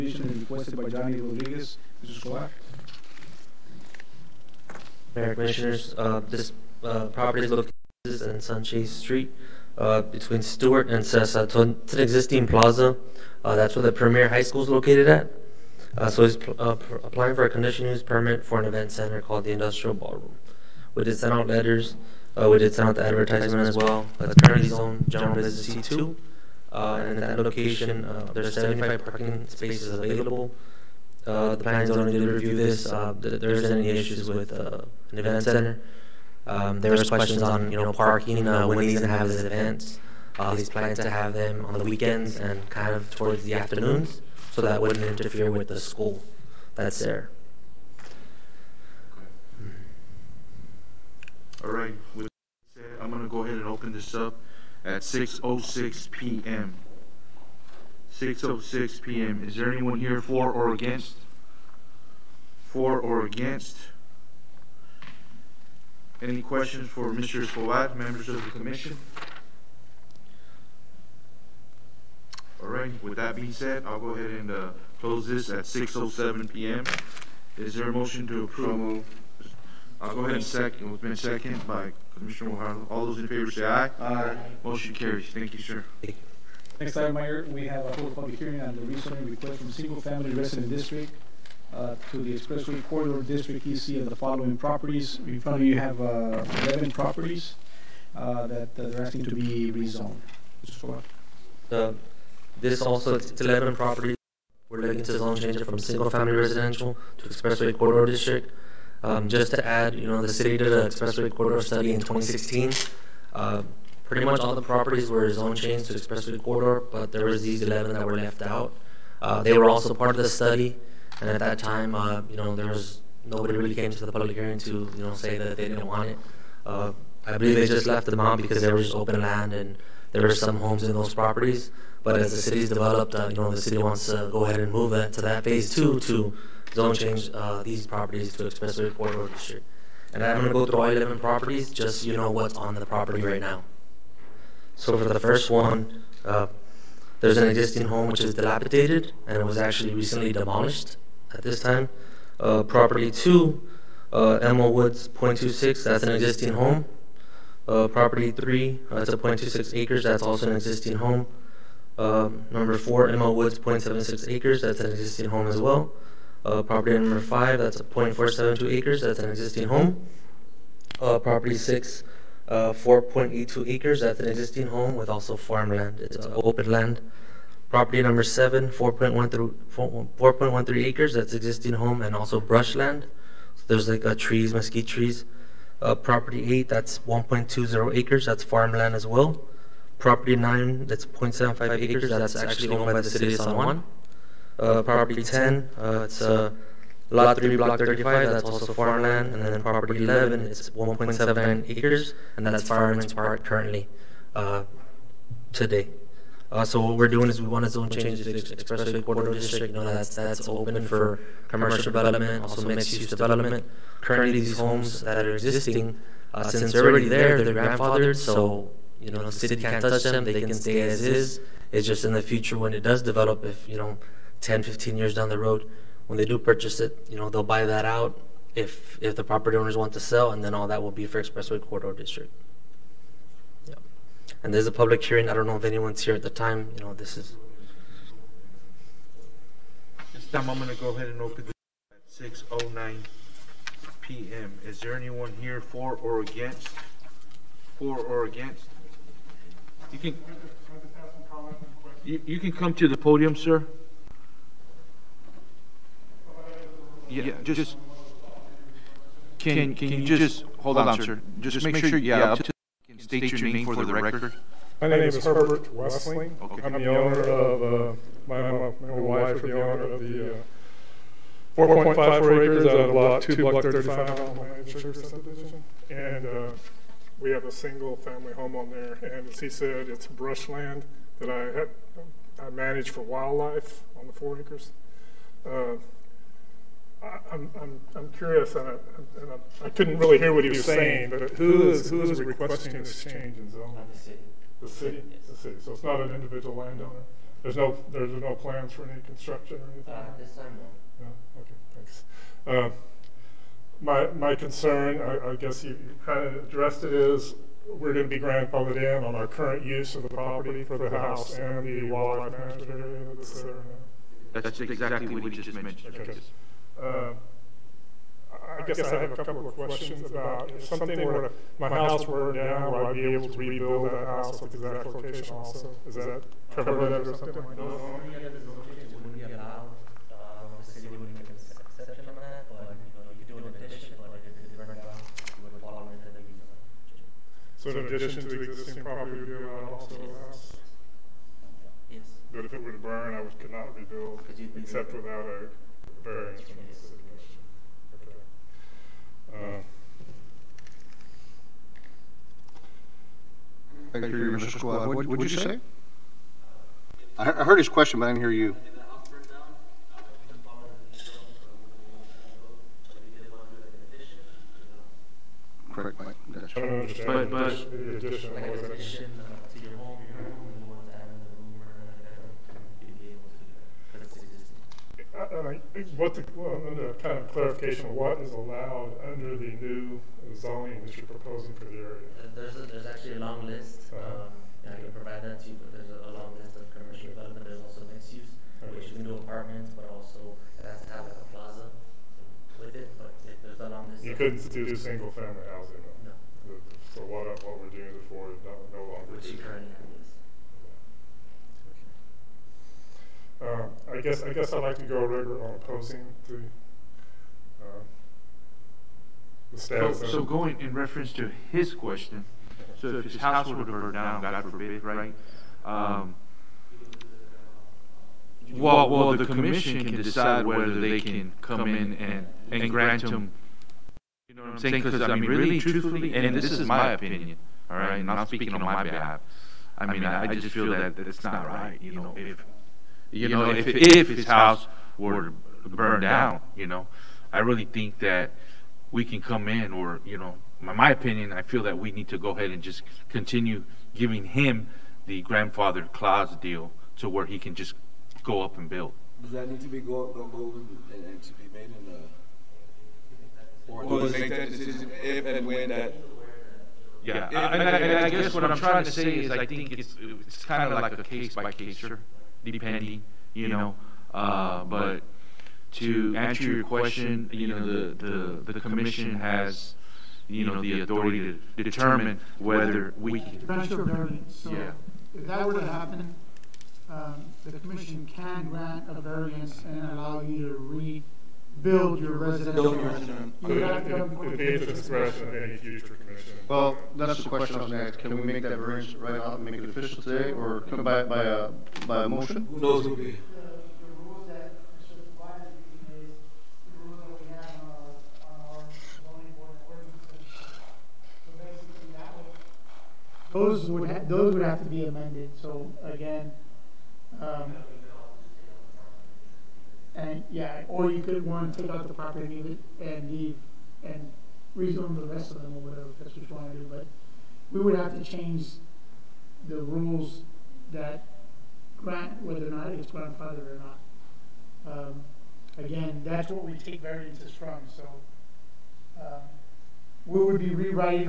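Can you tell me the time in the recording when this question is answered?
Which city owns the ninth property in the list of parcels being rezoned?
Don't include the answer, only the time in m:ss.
3:13.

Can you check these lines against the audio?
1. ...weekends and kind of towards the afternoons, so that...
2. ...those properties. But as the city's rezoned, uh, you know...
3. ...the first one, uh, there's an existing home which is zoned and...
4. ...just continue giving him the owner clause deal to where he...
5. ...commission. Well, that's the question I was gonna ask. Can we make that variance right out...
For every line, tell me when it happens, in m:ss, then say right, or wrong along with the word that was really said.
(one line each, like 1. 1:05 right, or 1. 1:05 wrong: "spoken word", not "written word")
1. 0:41 right
2. 2:10 wrong: "developed", not "rezoned"
3. 2:25 wrong: "dilapidated", not "zoned"
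4. 7:22 wrong: "grandfather", not "owner"
5. 8:05 right.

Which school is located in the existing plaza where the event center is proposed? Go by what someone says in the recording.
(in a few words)
Premier High School.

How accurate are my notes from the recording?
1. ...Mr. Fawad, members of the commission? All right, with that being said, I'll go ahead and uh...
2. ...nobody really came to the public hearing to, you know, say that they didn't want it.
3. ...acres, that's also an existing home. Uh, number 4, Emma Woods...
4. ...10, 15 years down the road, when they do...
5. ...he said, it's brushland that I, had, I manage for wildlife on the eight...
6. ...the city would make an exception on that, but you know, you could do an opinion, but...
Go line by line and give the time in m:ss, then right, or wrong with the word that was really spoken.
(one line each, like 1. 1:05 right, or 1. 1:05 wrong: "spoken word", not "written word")
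1. 1:07 right
2. 2:03 right
3. 2:39 right
4. 3:44 right
5. 4:39 wrong: "four", not "eight"
6. 5:30 wrong: "addition", not "opinion".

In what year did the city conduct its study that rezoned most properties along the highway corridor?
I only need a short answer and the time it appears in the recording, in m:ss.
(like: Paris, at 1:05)
2016, at 1:51.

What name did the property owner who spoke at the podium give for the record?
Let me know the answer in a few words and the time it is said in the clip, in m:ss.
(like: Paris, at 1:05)
Herbert Wesley, at 4:25.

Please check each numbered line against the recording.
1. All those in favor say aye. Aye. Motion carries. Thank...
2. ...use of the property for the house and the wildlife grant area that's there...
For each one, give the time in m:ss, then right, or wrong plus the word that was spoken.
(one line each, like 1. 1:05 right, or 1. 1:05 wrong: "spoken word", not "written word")
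1. 1:22 right
2. 5:09 wrong: "management", not "grant".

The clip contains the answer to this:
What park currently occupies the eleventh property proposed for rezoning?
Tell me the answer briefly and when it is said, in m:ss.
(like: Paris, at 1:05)
Fireman's Park, at 3:22.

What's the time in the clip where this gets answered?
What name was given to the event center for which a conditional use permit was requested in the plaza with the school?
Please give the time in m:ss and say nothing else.
0:19.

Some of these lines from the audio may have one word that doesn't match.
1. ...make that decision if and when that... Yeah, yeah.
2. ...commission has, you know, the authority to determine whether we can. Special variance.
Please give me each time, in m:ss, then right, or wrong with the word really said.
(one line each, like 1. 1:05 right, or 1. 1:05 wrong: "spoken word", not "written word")
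1. 7:34 right
2. 7:48 right.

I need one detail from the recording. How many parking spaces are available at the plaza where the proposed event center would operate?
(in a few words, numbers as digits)
75.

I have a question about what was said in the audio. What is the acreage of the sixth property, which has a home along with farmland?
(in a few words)
4.82 acres.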